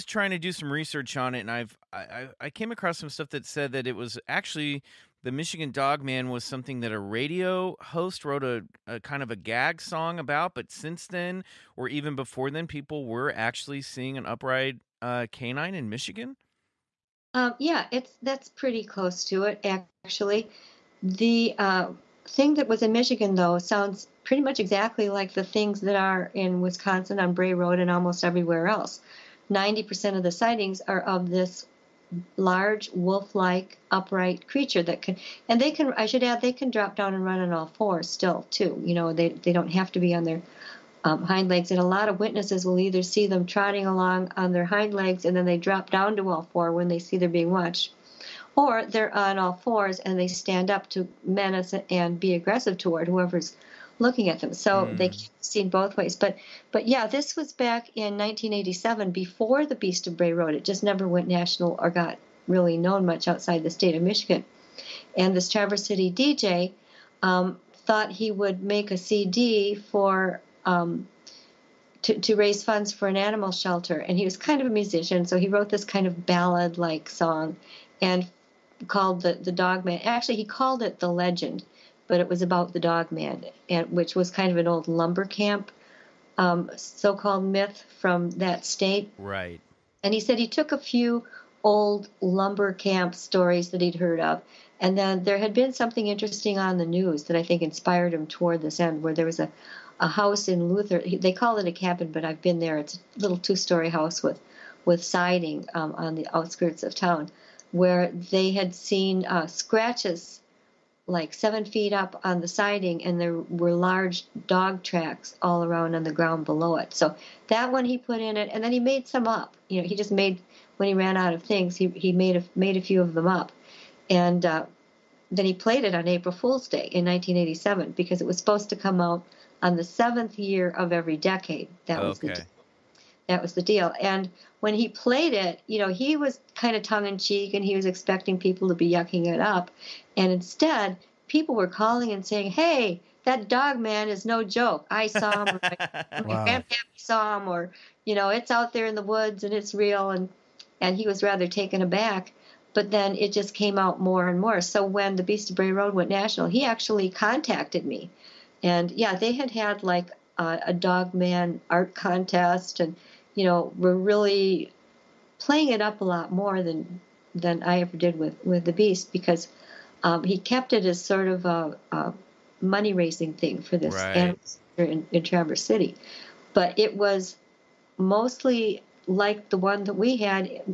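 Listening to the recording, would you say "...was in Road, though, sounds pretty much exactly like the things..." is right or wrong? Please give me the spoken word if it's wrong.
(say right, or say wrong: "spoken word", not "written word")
wrong: "Michigan", not "Road".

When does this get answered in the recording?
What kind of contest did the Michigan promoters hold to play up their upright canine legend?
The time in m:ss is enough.
2:40.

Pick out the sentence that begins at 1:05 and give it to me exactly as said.
And this Traverse City DJ um, thought he would make a CD for.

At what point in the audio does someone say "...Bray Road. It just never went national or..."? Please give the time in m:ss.
1:00.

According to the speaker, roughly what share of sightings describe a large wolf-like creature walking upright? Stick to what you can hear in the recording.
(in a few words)
90%.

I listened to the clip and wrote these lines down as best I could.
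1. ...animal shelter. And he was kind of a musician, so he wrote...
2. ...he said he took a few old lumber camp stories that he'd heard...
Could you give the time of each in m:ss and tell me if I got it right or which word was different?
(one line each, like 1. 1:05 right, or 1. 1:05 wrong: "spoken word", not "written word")
1. 1:13 right
2. 1:30 right.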